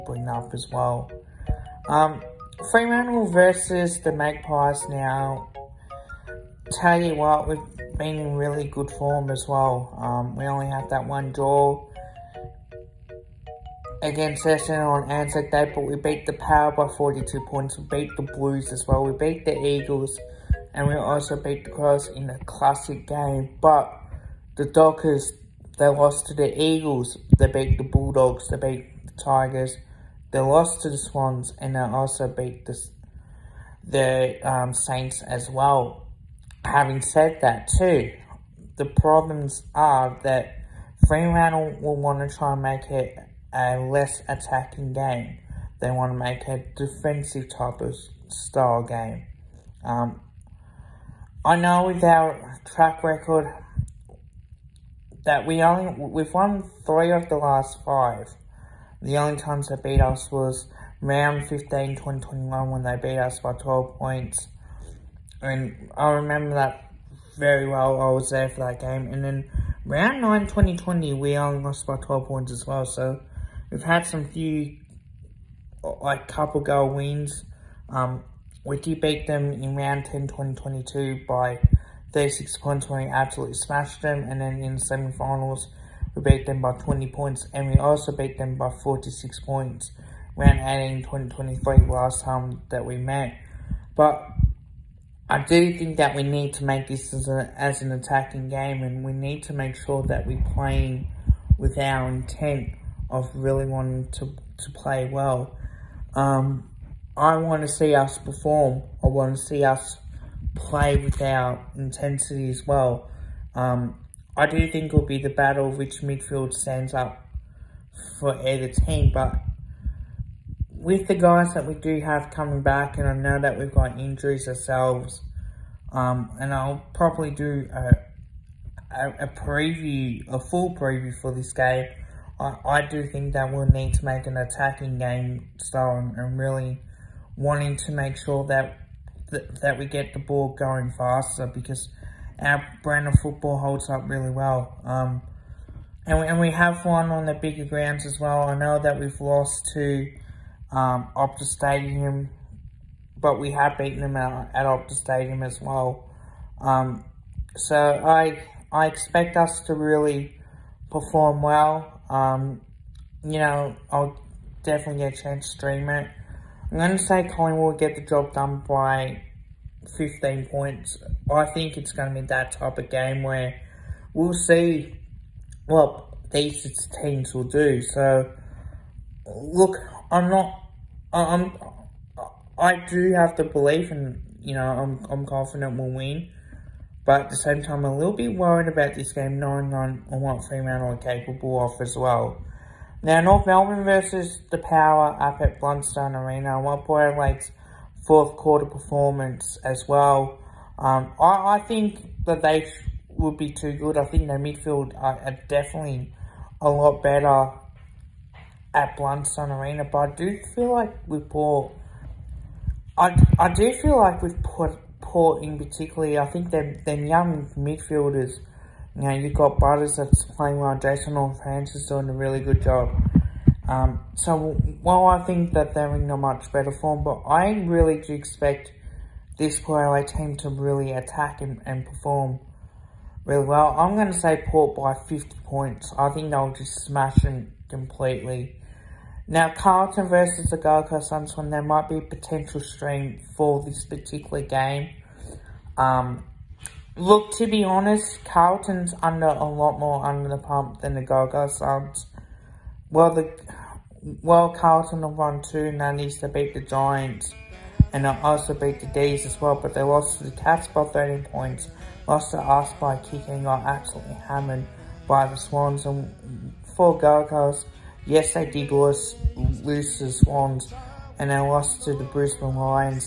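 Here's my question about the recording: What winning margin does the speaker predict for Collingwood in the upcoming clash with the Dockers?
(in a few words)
15 points.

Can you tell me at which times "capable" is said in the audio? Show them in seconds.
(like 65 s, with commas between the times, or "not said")
190 s.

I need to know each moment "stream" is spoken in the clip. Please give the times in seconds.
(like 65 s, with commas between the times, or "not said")
165 s, 242 s.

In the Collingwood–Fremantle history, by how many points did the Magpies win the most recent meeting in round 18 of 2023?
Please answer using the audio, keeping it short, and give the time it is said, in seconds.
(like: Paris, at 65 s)
46, at 88 s.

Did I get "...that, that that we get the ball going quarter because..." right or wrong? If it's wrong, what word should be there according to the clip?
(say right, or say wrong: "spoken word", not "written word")
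wrong: "faster", not "quarter".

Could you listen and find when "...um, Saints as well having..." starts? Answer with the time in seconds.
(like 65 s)
34 s.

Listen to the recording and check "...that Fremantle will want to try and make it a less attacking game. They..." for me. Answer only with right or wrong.
right.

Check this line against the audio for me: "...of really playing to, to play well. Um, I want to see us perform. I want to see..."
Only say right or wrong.
wrong.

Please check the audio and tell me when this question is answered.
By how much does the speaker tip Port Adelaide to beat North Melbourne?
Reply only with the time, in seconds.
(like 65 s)
235 s.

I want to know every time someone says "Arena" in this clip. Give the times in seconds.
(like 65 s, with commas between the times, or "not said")
196 s, 209 s.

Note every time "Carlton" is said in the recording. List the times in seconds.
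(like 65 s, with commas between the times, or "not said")
239 s, 248 s, 254 s.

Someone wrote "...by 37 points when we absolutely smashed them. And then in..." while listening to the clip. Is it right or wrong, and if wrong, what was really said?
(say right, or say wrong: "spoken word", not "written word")
wrong: "36", not "37".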